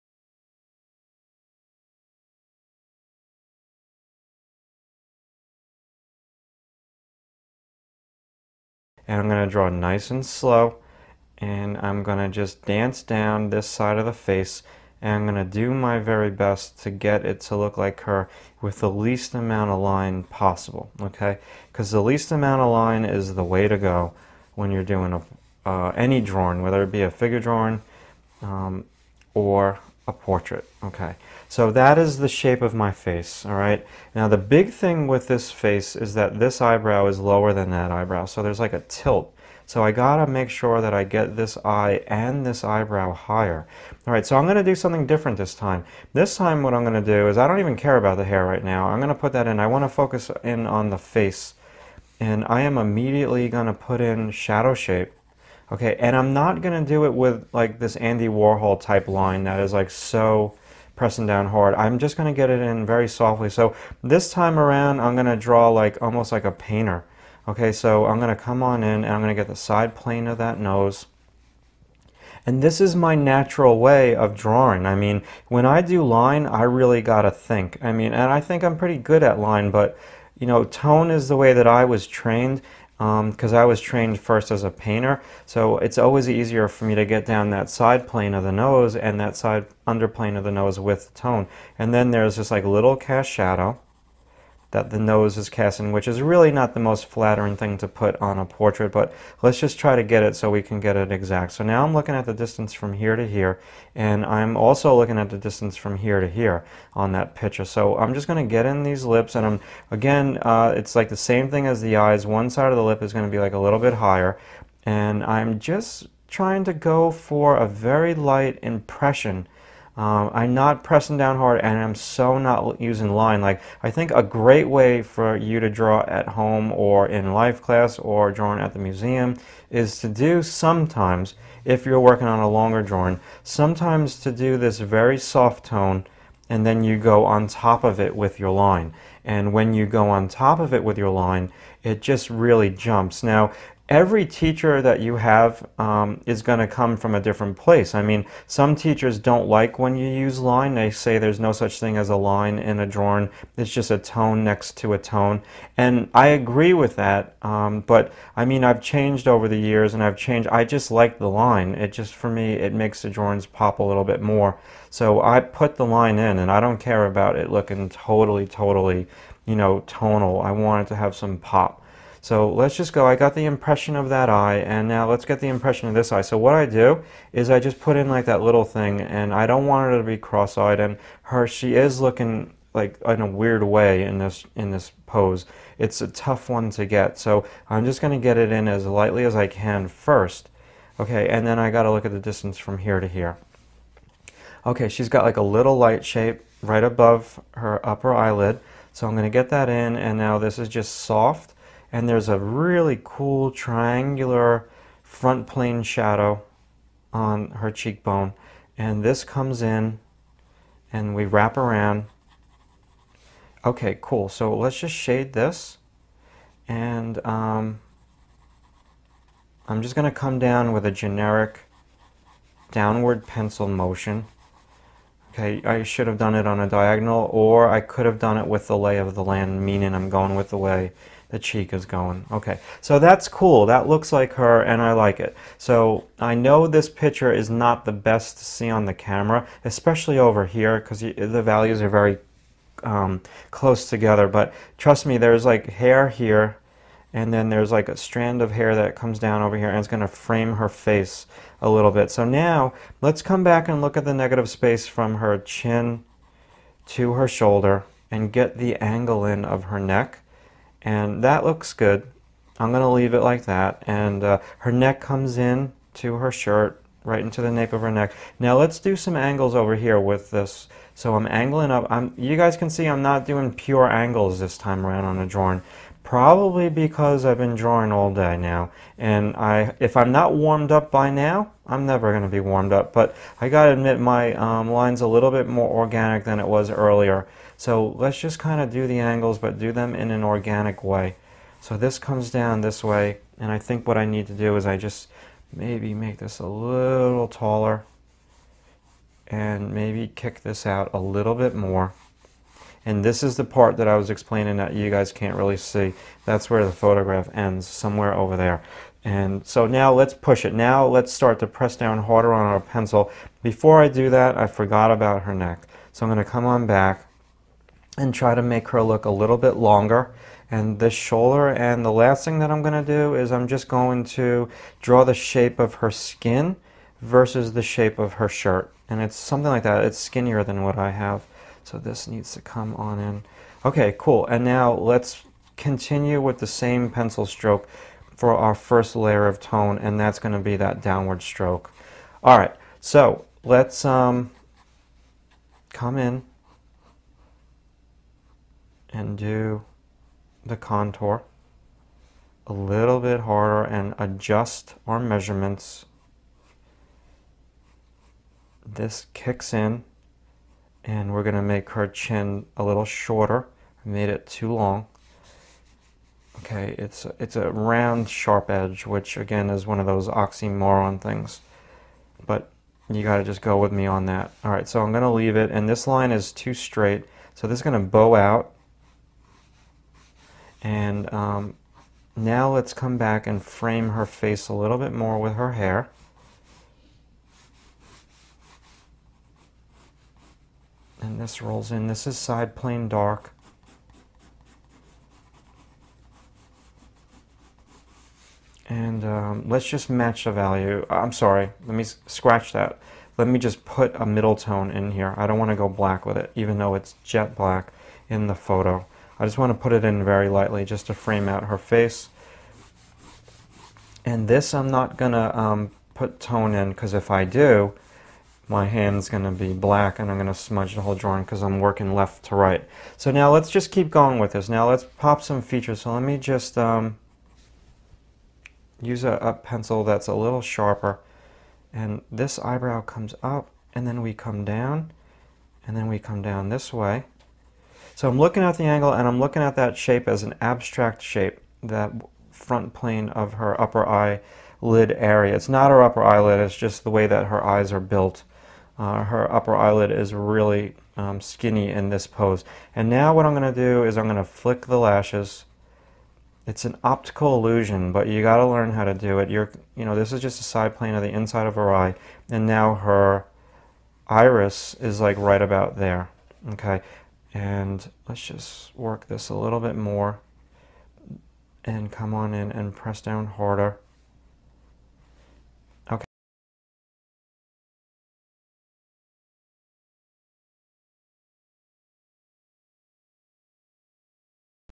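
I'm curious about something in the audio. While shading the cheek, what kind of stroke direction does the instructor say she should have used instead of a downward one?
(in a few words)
diagonal.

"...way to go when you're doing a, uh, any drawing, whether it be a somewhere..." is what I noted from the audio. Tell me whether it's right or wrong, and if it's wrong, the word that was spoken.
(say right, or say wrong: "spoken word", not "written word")
wrong: "figure", not "somewhere".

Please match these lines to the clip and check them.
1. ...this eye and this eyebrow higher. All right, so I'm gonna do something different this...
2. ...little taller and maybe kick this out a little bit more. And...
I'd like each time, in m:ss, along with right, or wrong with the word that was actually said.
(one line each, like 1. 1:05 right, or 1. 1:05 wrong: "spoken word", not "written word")
1. 0:41 right
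2. 4:56 right.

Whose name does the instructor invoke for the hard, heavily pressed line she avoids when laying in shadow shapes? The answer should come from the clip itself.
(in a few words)
Andy Warhol.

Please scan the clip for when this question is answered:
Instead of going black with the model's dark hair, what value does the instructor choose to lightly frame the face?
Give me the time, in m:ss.
6:44.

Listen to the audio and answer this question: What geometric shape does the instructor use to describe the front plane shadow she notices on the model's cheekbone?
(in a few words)
triangular.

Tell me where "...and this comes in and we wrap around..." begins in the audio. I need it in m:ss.
3:28.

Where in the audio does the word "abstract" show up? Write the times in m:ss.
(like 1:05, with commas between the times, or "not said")
7:20.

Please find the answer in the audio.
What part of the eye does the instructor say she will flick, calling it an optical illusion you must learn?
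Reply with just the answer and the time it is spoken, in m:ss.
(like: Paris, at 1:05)
lashes, at 7:34.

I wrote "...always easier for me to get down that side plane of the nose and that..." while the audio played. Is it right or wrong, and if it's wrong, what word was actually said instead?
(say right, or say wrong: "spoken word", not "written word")
right.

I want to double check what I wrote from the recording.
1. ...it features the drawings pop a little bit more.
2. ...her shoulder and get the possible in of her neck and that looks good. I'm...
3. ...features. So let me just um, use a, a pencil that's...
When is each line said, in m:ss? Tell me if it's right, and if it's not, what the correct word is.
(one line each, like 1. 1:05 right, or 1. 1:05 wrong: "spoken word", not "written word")
1. 2:42 wrong: "makes", not "features"
2. 4:17 wrong: "angle", not "possible"
3. 7:05 right.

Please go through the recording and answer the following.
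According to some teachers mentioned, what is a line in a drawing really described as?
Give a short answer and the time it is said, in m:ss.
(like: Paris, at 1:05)
a tone next to a tone, at 2:33.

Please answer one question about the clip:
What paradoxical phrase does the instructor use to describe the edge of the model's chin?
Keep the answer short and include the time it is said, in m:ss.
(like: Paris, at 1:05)
round sharp edge, at 6:07.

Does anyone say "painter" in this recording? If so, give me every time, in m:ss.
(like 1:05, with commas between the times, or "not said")
1:06, 1:24.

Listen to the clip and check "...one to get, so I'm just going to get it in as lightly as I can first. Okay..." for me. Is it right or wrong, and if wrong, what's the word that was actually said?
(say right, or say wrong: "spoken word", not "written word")
right.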